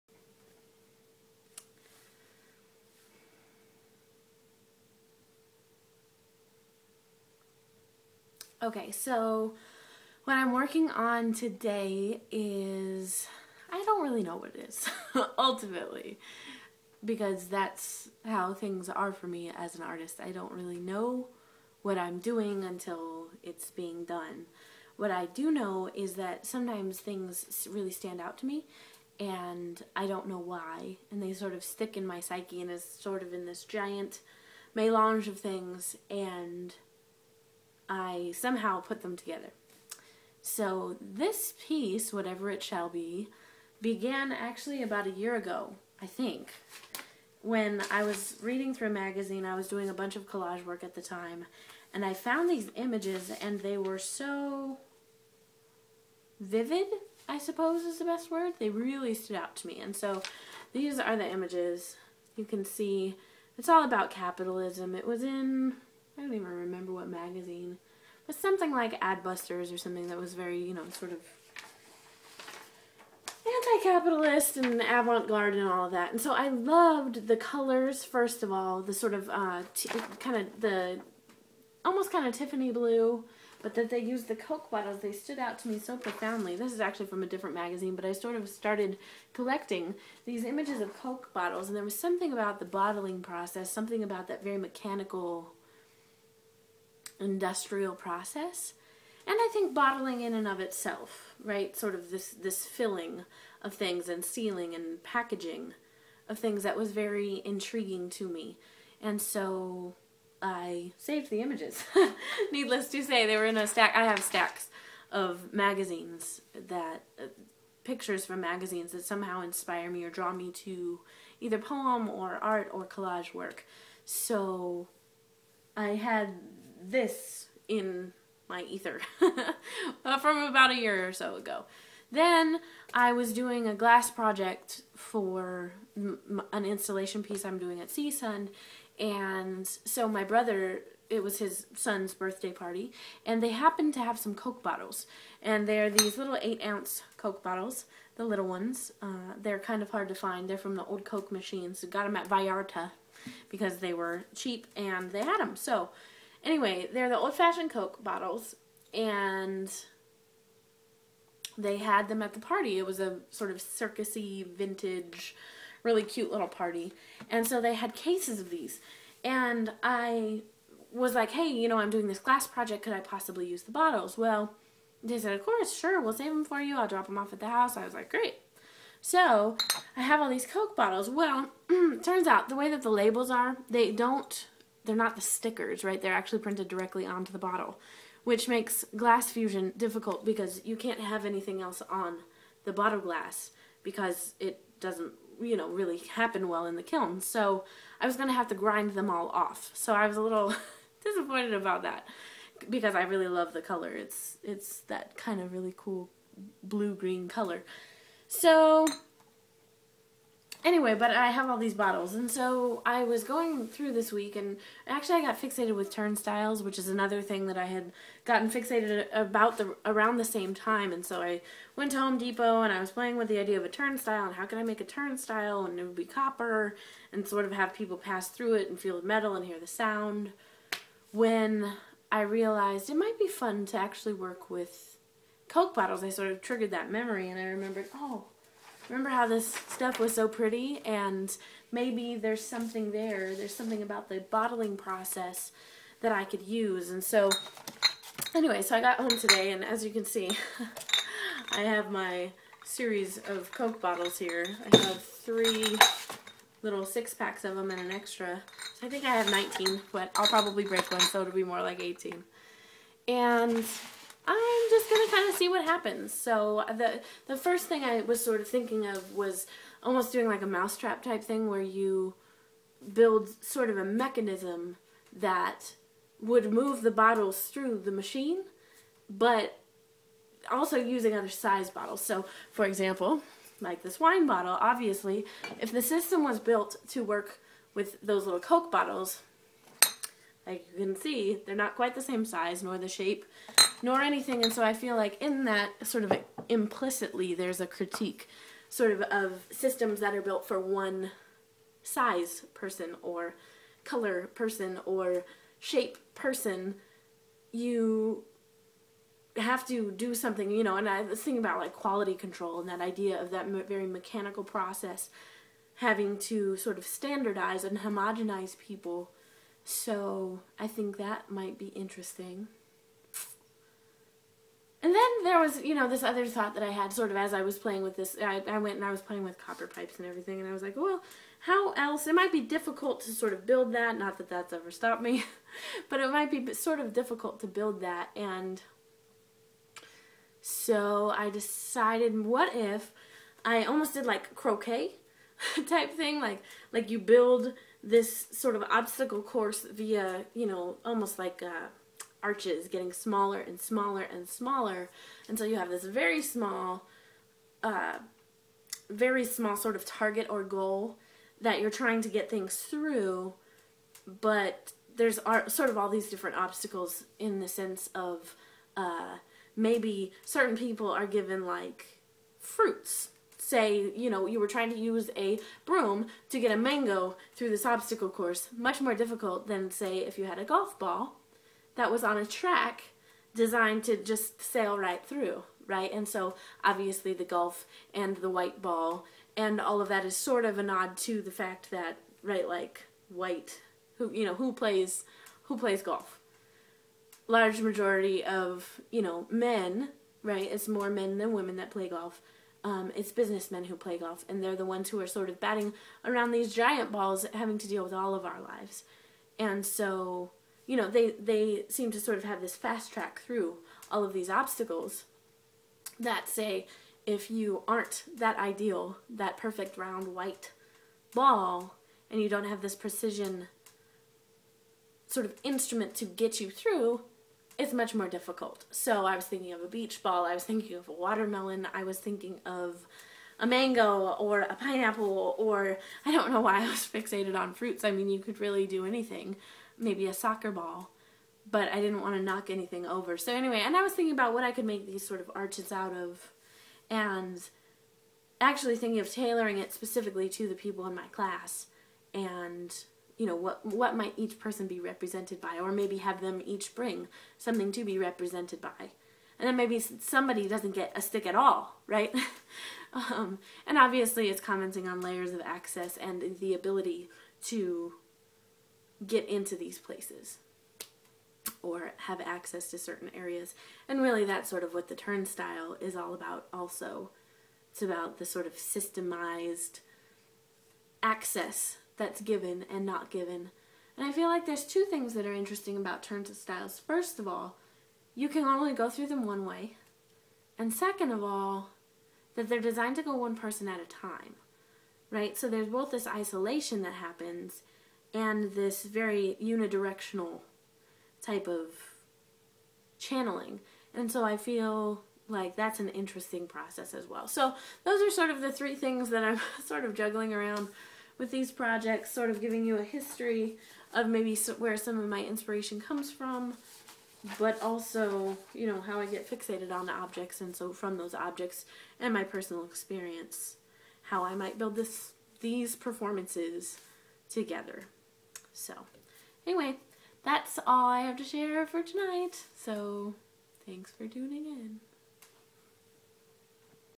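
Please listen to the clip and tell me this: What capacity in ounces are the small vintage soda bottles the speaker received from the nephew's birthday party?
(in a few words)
8.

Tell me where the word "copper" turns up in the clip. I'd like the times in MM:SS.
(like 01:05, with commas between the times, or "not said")
03:46, 05:29.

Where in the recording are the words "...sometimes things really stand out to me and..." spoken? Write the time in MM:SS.
00:26.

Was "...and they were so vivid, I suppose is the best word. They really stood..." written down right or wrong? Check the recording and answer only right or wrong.
right.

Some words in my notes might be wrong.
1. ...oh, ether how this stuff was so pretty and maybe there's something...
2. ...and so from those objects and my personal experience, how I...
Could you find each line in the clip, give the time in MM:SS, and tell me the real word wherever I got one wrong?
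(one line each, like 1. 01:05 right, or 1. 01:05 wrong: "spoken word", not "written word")
1. 03:57 wrong: "remember", not "ether"
2. 08:40 right.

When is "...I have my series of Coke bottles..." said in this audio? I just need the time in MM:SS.
04:11.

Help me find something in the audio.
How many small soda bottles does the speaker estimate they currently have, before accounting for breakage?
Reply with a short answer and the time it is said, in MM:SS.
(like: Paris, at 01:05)
19, at 04:19.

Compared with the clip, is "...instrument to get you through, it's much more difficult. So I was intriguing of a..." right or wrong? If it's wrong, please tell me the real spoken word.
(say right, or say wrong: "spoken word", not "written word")
wrong: "thinking", not "intriguing".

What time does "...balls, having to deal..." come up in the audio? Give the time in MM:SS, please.
06:46.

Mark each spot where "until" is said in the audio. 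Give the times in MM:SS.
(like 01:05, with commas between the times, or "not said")
00:22, 05:55.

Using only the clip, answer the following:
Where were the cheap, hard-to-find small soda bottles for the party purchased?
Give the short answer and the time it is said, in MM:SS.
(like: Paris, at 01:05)
Vallarta, at 02:32.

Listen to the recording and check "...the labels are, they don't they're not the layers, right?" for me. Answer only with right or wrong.
wrong.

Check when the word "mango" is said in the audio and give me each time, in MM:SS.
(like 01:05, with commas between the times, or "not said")
06:16, 07:13.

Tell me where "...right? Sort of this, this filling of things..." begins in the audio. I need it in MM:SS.
01:41.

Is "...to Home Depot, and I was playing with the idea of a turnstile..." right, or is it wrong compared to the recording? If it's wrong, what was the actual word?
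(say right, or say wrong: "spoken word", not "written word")
right.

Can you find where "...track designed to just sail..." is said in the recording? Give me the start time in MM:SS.
06:22.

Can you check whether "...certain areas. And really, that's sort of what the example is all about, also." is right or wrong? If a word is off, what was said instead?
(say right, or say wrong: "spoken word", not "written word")
wrong: "turnstile", not "example".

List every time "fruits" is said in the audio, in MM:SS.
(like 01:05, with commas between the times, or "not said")
06:12, 07:17.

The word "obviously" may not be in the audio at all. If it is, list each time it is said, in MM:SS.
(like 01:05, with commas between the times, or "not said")
04:44, 06:26, 07:43.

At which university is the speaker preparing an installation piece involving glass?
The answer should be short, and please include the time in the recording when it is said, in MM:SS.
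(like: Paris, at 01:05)
CSUN, at 02:17.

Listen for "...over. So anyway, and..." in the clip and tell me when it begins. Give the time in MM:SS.
07:22.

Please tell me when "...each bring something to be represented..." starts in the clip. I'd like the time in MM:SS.
07:36.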